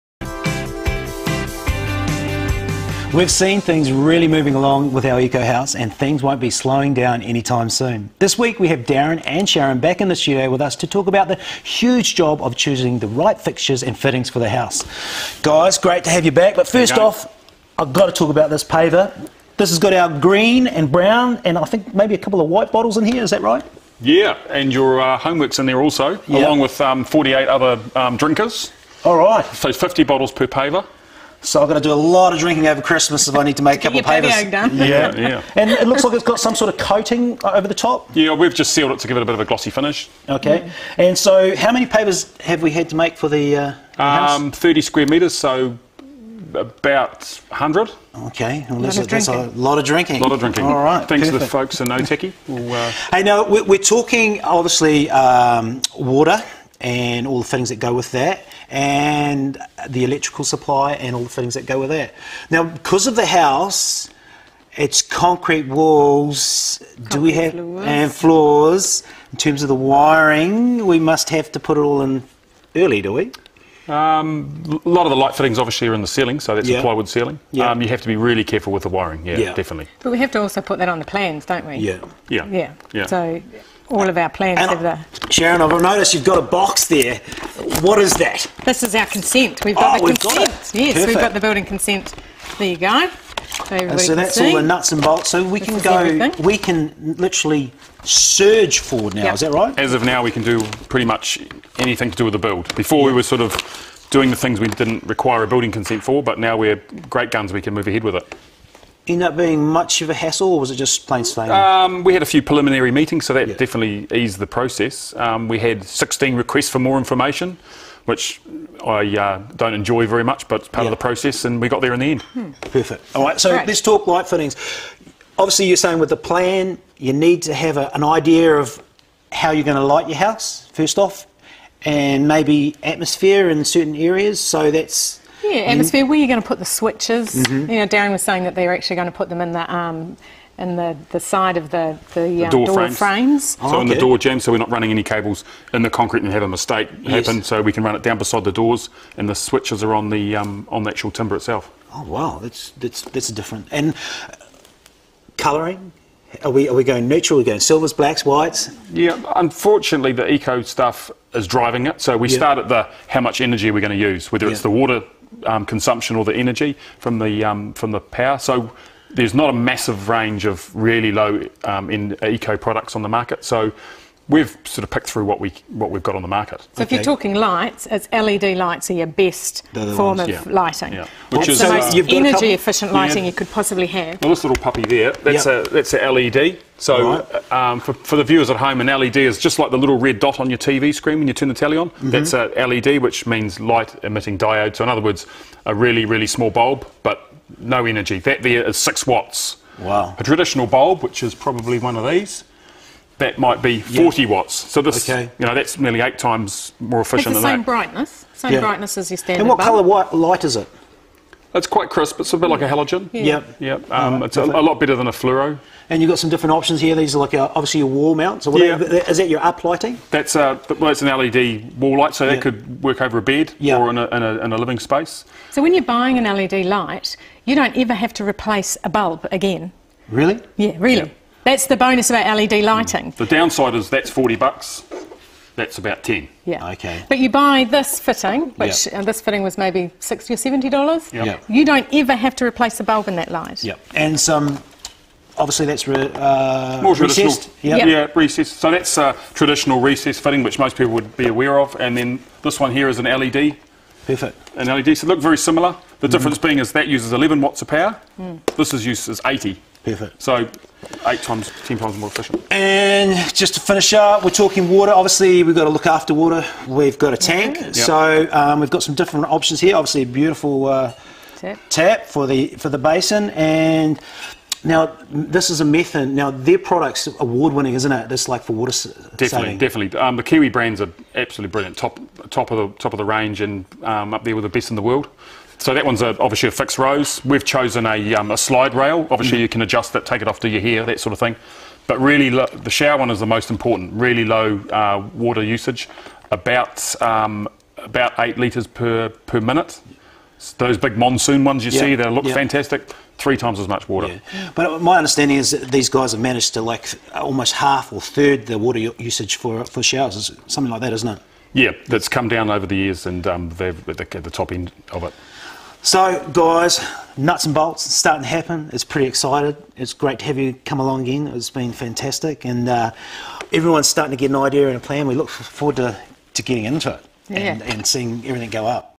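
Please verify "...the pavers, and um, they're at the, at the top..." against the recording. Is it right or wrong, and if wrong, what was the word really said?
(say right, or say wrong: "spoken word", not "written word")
wrong: "years", not "pavers".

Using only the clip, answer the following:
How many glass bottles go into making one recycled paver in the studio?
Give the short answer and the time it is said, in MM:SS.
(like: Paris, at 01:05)
50, at 00:29.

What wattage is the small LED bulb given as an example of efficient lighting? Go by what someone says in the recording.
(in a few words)
6 watts.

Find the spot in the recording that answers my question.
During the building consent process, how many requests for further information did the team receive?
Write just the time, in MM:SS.
01:55.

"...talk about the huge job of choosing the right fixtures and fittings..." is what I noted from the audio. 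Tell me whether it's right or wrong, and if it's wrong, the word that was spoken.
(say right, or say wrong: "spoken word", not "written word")
right.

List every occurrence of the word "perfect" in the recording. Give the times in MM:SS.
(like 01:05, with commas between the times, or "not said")
00:51, 01:30, 02:02, 04:14, 04:19.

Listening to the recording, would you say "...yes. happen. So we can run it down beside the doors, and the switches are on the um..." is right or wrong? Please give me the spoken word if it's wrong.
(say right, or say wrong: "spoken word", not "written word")
right.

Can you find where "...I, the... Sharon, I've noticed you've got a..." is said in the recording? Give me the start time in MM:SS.
01:24.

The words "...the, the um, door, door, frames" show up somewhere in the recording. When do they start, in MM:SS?
02:22.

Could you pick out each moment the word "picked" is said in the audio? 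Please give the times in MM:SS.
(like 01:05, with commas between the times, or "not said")
02:54.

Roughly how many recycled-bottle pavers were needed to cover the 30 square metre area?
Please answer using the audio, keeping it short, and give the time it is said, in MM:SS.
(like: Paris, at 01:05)
100, at 00:46.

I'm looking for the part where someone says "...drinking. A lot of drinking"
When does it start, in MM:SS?
00:49.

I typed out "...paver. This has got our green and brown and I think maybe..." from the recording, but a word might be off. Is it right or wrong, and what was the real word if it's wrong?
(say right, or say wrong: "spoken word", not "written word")
right.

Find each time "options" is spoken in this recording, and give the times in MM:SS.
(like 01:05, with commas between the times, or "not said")
03:36, 04:29.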